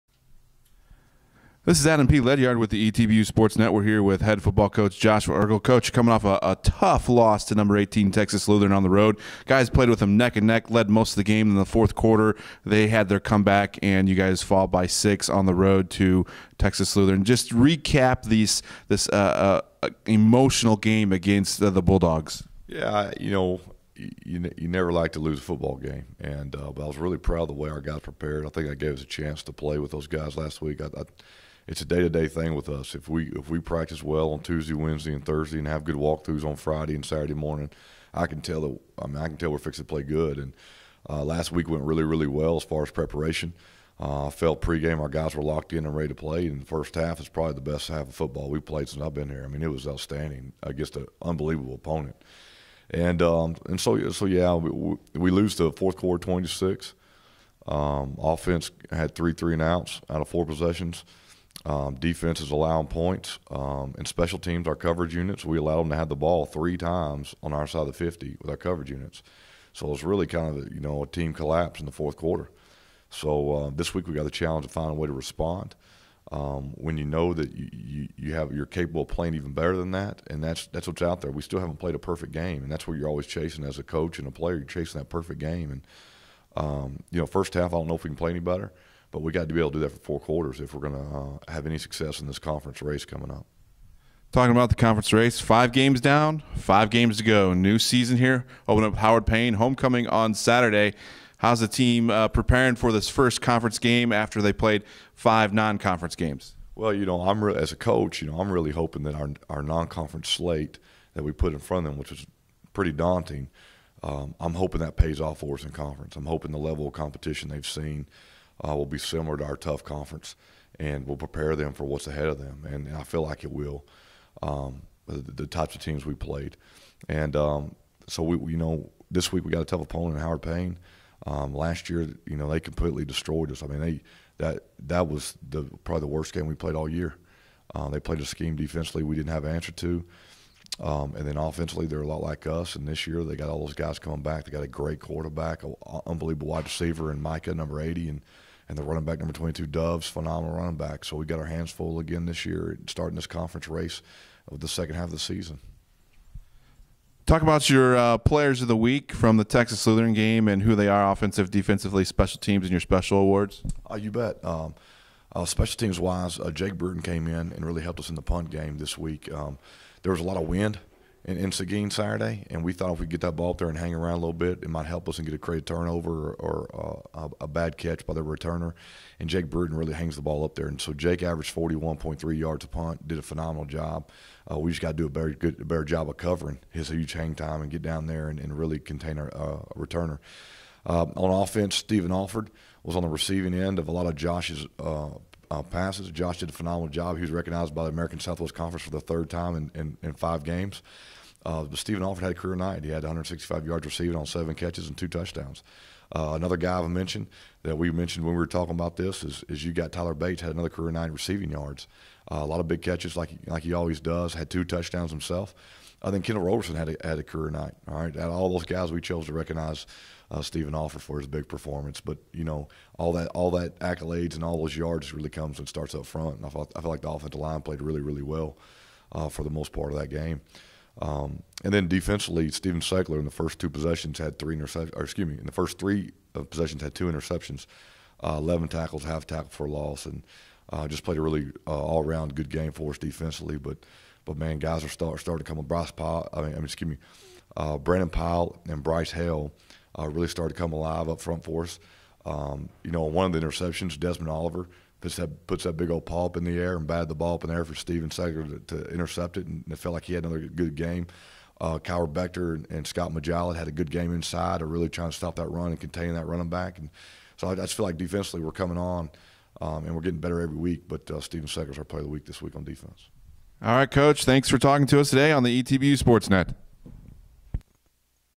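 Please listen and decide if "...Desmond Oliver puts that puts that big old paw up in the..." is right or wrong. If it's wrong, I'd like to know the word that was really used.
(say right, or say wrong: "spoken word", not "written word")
right.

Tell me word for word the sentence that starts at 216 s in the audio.
I think Kendall Roberson had a, had a career night.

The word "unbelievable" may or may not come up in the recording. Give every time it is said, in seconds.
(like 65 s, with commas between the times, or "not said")
51 s, 146 s.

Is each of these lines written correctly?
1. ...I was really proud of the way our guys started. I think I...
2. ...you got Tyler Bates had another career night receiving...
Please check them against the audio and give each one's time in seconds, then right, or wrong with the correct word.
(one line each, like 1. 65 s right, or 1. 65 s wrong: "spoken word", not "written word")
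1. 26 s wrong: "prepared", not "started"
2. 209 s right.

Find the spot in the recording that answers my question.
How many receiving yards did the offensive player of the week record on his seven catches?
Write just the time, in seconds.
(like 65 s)
203 s.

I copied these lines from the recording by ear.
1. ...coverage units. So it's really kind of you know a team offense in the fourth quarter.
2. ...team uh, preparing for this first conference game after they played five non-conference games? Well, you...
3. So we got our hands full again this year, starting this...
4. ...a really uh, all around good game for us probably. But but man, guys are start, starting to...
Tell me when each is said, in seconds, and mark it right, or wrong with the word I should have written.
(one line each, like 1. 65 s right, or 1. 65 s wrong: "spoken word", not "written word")
1. 68 s wrong: "collapse", not "offense"
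2. 101 s right
3. 151 s right
4. 241 s wrong: "defensively", not "probably".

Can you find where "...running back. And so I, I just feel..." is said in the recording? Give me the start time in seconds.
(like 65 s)
266 s.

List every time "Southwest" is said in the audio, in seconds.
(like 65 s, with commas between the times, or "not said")
198 s.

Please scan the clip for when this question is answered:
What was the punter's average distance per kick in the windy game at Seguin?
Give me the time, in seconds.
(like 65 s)
181 s.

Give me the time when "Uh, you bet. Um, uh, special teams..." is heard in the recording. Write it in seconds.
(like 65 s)
163 s.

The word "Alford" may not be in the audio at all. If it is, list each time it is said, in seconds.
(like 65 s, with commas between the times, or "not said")
192 s, 202 s, 220 s.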